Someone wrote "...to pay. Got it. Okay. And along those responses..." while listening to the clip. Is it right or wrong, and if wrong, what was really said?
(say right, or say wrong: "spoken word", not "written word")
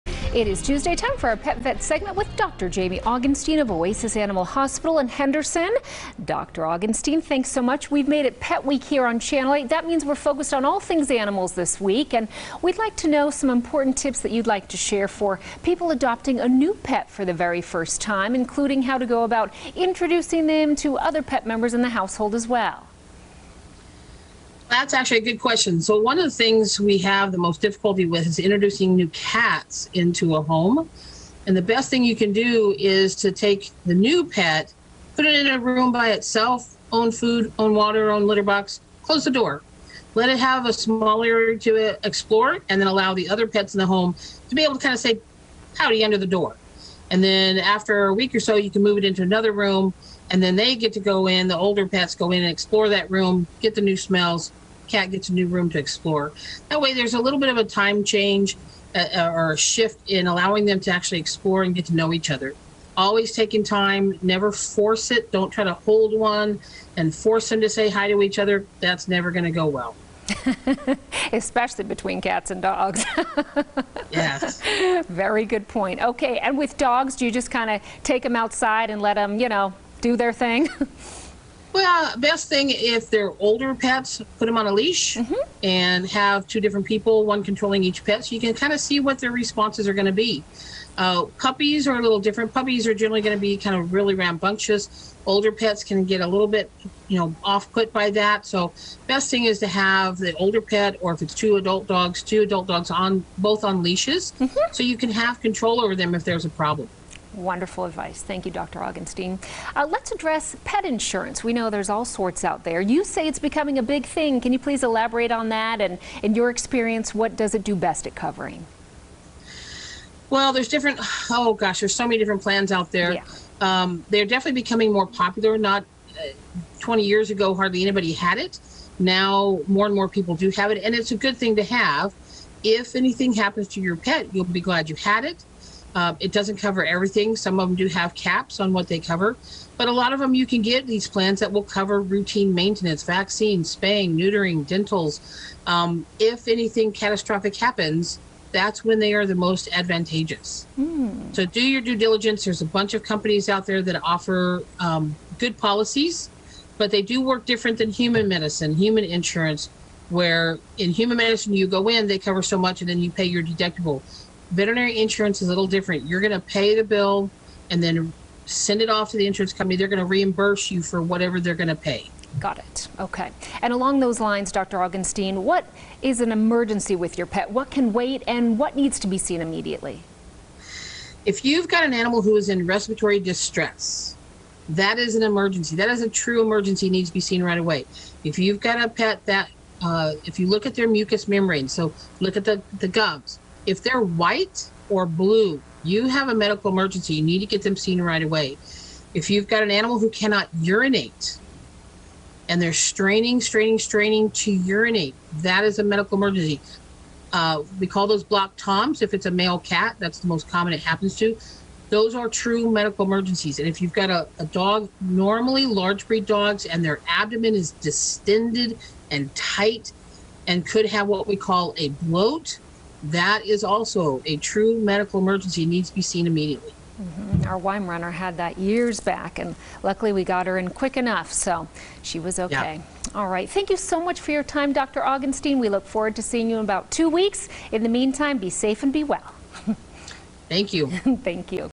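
wrong: "lines", not "responses".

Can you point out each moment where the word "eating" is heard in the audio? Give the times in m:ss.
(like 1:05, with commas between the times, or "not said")
not said.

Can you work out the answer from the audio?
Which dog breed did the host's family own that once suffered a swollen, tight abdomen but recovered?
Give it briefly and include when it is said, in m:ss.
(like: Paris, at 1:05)
Weimaraner, at 3:47.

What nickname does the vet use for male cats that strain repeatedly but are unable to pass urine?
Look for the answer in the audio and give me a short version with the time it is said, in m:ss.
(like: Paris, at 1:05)
blocked toms, at 3:28.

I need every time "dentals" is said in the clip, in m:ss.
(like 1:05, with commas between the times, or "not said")
2:24.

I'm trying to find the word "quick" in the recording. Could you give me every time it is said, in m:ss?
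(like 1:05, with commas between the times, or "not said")
3:50.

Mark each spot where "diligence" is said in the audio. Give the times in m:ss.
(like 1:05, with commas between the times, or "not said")
2:31.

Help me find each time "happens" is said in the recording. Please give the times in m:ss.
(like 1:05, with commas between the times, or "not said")
2:13, 2:27, 3:30.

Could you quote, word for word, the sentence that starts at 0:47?
And then after a week or so, you can move it into another room, and then they get to go in.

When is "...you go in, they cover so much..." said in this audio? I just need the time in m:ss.
2:41.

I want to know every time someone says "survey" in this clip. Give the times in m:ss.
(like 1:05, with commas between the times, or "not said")
not said.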